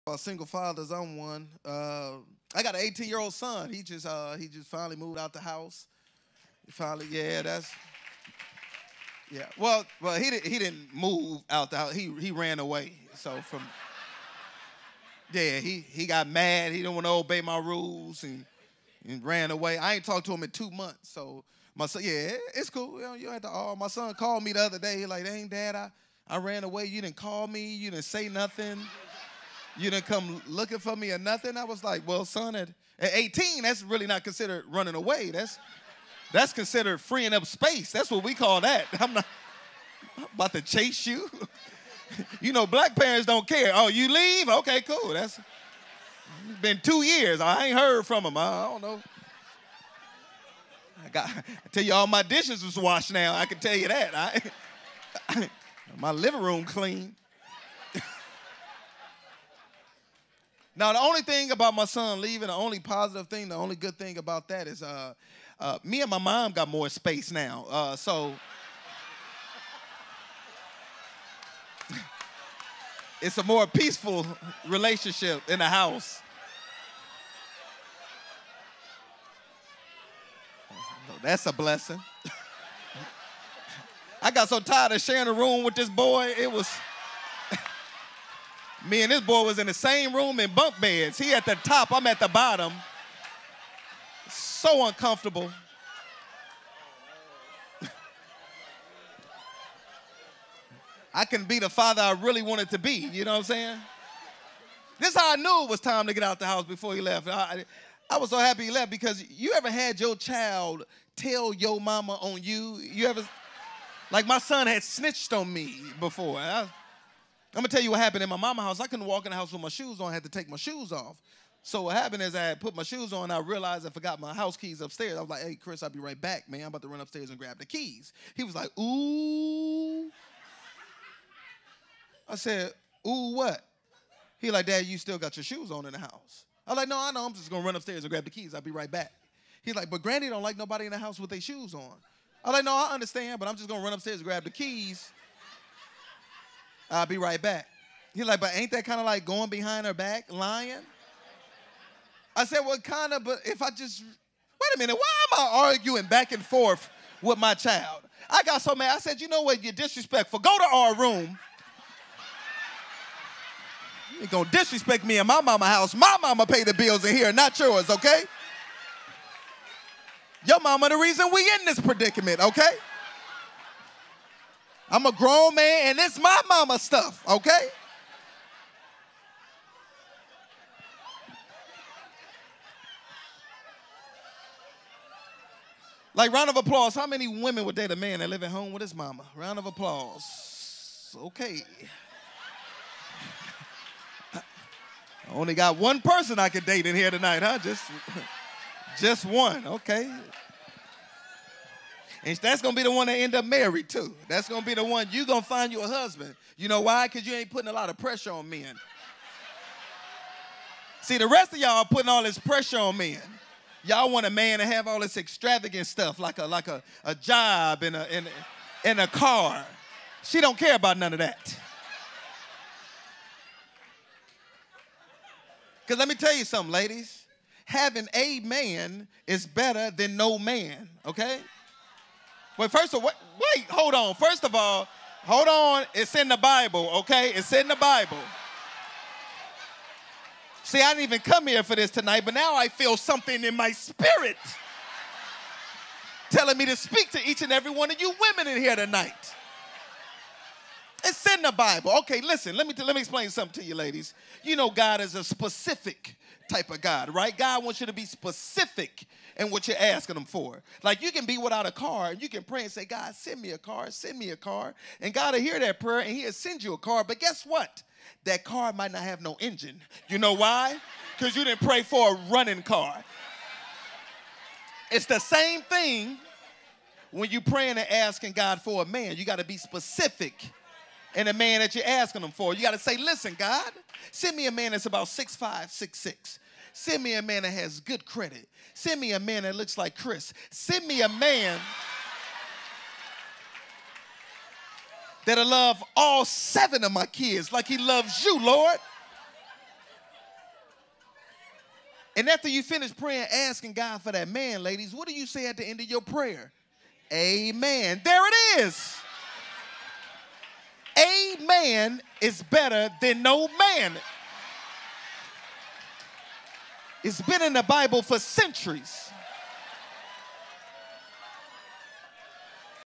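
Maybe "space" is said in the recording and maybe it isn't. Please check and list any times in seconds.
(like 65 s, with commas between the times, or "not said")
37 s, 66 s.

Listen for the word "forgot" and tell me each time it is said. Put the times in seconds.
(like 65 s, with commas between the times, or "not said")
123 s.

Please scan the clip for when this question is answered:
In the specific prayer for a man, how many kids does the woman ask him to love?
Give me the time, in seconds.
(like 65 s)
296 s.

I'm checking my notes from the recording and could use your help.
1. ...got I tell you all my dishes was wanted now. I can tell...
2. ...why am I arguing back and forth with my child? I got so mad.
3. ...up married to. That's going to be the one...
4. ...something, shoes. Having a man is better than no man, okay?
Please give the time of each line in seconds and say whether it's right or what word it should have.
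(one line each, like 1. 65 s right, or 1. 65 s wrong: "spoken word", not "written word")
1. 51 s wrong: "washed", not "wanted"
2. 154 s right
3. 203 s right
4. 226 s wrong: "ladies", not "shoes".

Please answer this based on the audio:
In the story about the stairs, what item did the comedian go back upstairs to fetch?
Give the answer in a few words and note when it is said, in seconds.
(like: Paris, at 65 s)
House keys, at 124 s.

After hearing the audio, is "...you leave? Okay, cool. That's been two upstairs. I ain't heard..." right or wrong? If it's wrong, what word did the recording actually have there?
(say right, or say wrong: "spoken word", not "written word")
wrong: "years", not "upstairs".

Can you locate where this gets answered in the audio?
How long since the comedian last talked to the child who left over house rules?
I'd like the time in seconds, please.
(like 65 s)
20 s.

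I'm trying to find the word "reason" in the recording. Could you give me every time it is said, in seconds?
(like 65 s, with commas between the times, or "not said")
170 s.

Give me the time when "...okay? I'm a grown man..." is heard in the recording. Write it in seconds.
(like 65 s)
172 s.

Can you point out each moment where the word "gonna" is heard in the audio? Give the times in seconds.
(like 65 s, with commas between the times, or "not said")
117 s, 137 s, 143 s, 164 s.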